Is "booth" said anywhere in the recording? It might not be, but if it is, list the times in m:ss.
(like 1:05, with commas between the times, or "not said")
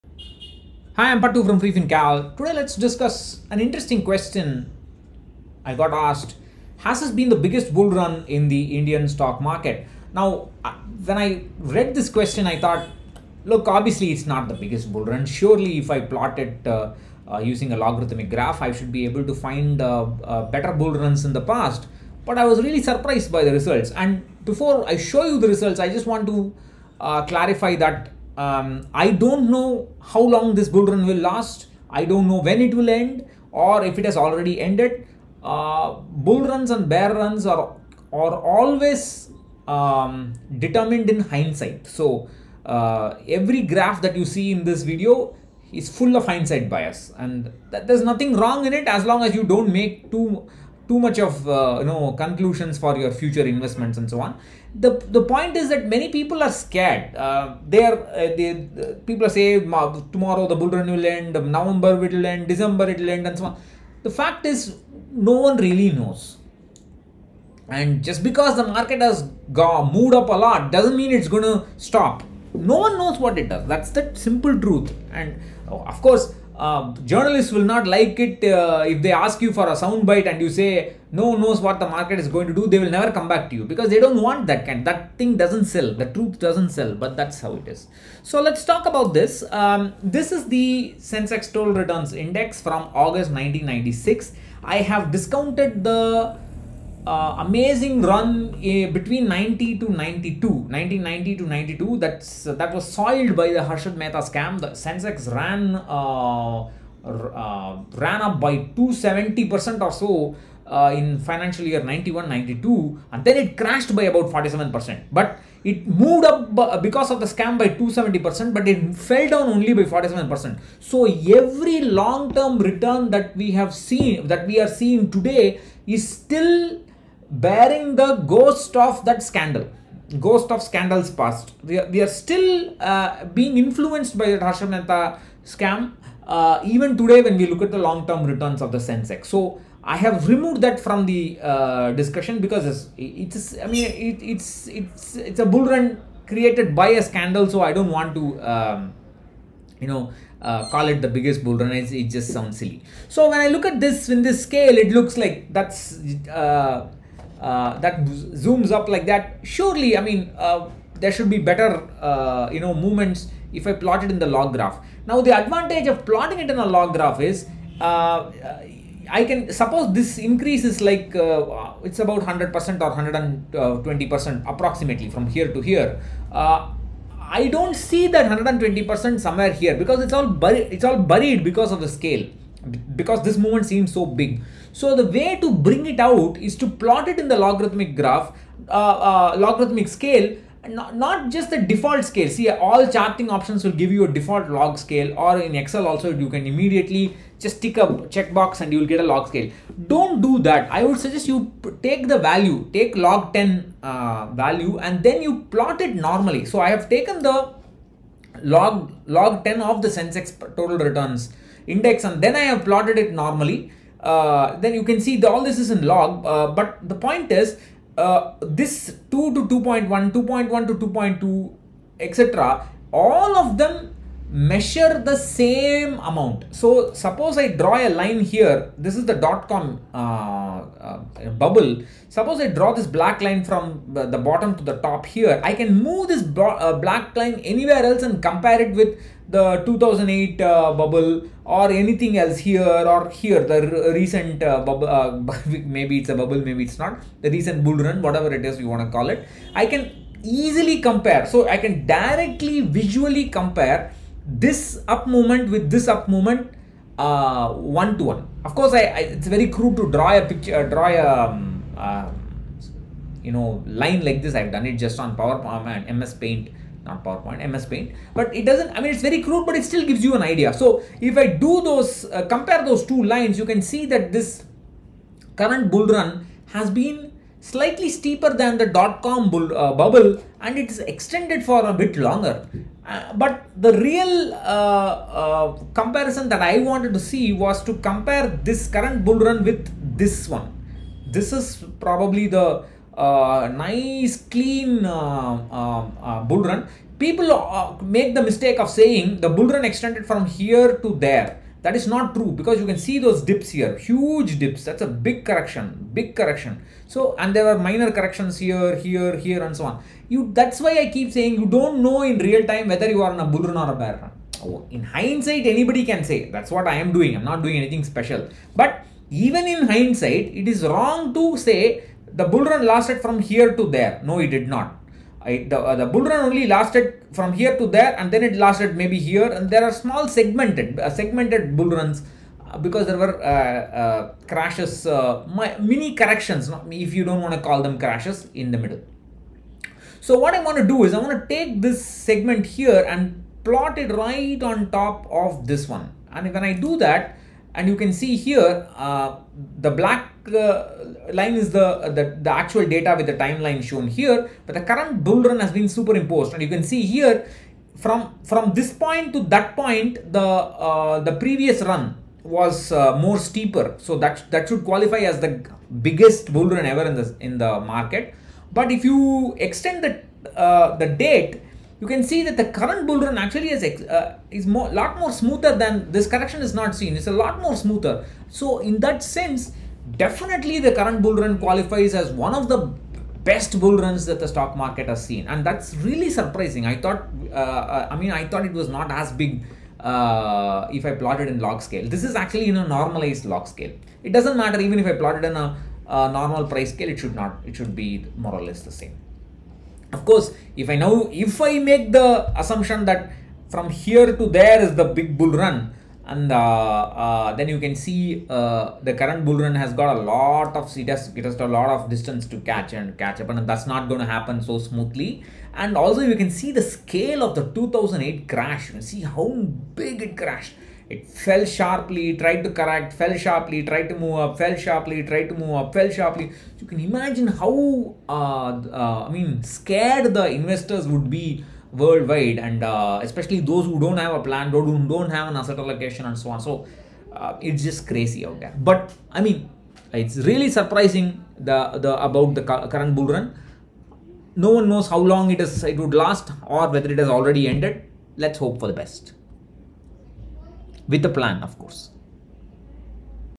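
not said.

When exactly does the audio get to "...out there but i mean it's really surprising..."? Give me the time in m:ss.
7:18.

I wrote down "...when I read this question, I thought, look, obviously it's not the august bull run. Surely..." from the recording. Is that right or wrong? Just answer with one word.
wrong.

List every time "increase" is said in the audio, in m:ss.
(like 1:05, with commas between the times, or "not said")
2:50.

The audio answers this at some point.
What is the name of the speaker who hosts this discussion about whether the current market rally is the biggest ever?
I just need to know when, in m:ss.
0:01.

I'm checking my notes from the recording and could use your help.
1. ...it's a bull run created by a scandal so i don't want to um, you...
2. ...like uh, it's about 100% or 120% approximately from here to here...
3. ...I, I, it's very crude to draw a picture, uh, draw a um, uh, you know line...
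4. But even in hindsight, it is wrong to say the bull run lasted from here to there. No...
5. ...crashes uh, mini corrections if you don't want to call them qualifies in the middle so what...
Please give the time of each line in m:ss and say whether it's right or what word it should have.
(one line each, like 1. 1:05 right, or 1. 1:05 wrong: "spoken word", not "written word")
1. 2:25 right
2. 2:50 right
3. 4:18 right
4. 5:18 right
5. 5:34 wrong: "crashes", not "qualifies".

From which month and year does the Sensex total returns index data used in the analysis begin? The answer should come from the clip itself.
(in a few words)
August 1996.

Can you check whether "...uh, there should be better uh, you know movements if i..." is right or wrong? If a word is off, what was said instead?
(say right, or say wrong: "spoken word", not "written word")
right.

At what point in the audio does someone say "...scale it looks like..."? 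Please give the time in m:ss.
2:34.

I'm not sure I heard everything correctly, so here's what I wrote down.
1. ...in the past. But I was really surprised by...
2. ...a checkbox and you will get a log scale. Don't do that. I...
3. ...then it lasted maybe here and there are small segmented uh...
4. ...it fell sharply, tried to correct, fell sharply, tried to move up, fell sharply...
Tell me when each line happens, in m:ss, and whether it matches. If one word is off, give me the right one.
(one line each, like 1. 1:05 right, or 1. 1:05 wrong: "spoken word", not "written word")
1. 0:21 right
2. 3:17 right
3. 5:28 right
4. 7:00 right.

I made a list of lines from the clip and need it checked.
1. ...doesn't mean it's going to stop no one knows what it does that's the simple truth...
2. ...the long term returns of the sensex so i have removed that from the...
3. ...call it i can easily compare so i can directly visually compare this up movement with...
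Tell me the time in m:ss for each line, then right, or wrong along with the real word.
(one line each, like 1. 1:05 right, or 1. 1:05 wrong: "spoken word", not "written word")
1. 1:10 right
2. 2:17 right
3. 4:08 right.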